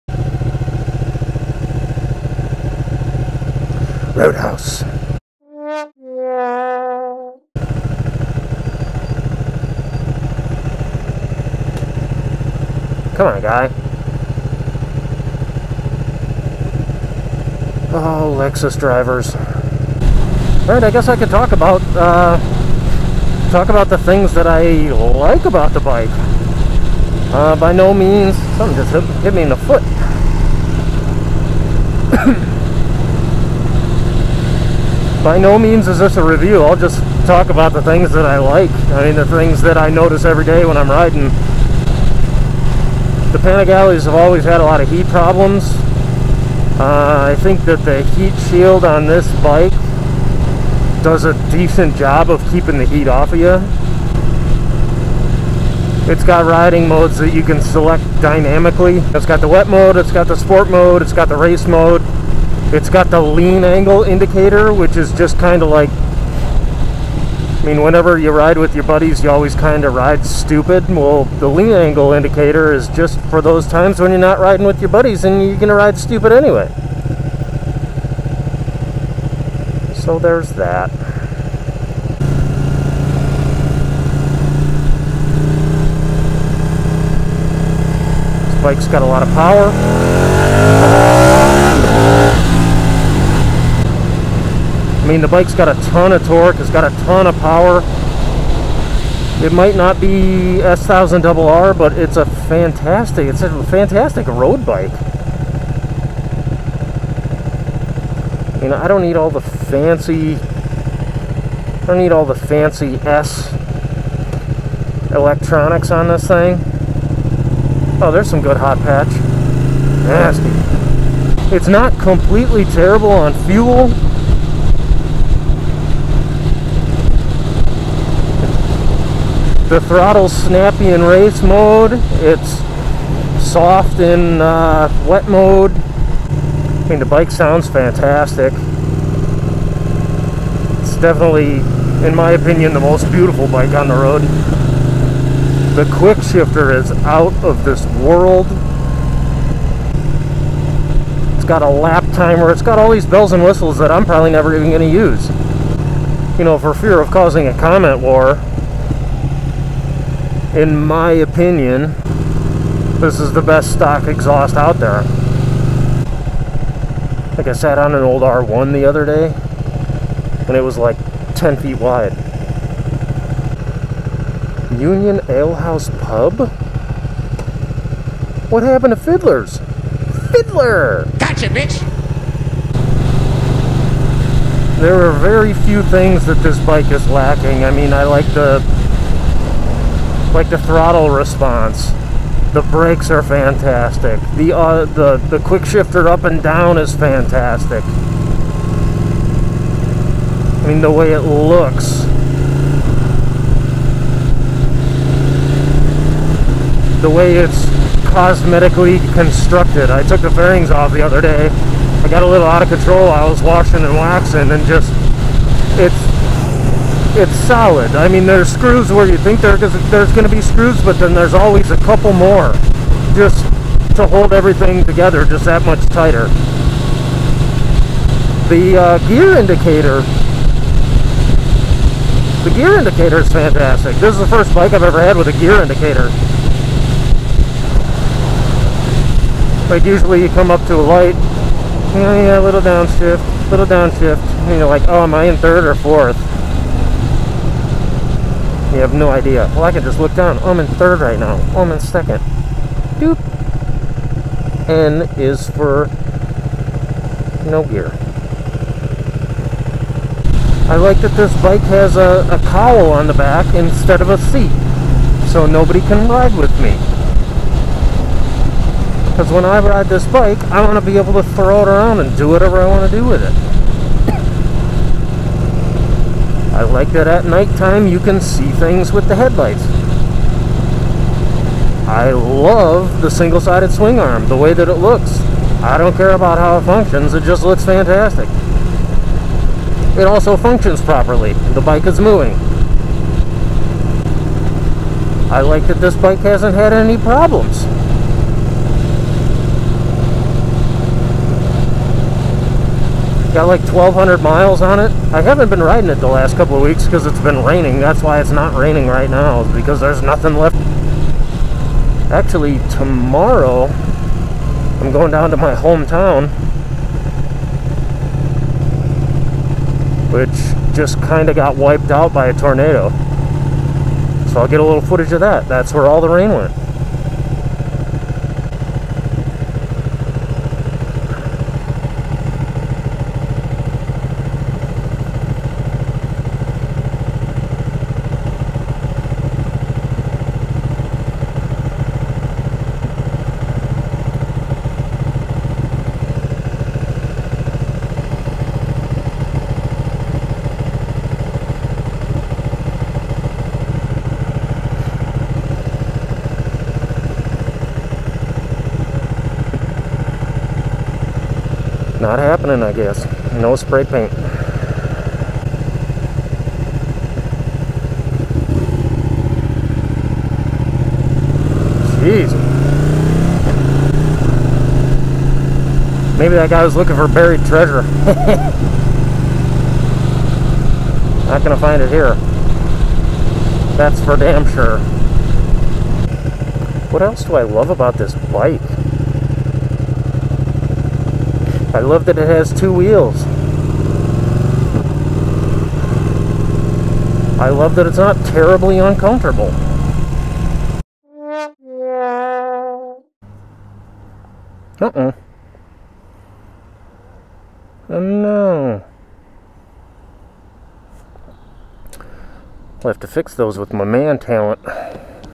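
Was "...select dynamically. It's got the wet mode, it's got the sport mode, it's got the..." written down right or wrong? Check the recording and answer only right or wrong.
right.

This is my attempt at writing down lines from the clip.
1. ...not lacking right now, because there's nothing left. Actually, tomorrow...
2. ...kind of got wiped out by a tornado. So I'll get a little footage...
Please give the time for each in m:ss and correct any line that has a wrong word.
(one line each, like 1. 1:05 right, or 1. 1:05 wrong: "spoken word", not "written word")
1. 5:08 wrong: "raining", not "lacking"
2. 5:21 right.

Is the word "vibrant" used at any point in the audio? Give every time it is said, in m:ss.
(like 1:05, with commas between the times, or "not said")
not said.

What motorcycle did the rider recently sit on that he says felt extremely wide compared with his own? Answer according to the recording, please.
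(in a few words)
R1.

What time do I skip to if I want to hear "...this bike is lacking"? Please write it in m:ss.
3:06.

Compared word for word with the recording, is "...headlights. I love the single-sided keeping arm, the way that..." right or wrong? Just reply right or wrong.
wrong.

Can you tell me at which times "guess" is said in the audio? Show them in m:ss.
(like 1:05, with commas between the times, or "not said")
0:20, 6:02.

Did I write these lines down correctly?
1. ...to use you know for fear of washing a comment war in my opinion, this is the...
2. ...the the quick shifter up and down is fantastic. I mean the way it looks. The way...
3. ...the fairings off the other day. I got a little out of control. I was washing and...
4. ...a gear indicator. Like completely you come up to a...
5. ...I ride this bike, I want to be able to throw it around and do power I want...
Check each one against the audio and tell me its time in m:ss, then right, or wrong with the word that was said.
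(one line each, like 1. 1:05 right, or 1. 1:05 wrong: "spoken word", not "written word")
1. 2:34 wrong: "causing", not "washing"
2. 3:14 right
3. 3:30 right
4. 3:55 wrong: "usually", not "completely"
5. 4:29 wrong: "whatever", not "power".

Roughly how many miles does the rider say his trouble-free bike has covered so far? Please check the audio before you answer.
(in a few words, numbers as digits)
1,200.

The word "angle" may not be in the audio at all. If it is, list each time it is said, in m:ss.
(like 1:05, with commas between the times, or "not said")
1:03, 1:11.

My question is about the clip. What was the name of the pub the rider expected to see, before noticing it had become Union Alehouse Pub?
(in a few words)
Fiddlers.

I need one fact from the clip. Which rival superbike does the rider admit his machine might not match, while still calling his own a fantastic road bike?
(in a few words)
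S1000RR.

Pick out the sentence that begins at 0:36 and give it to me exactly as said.
I'll just talk about the things that I like.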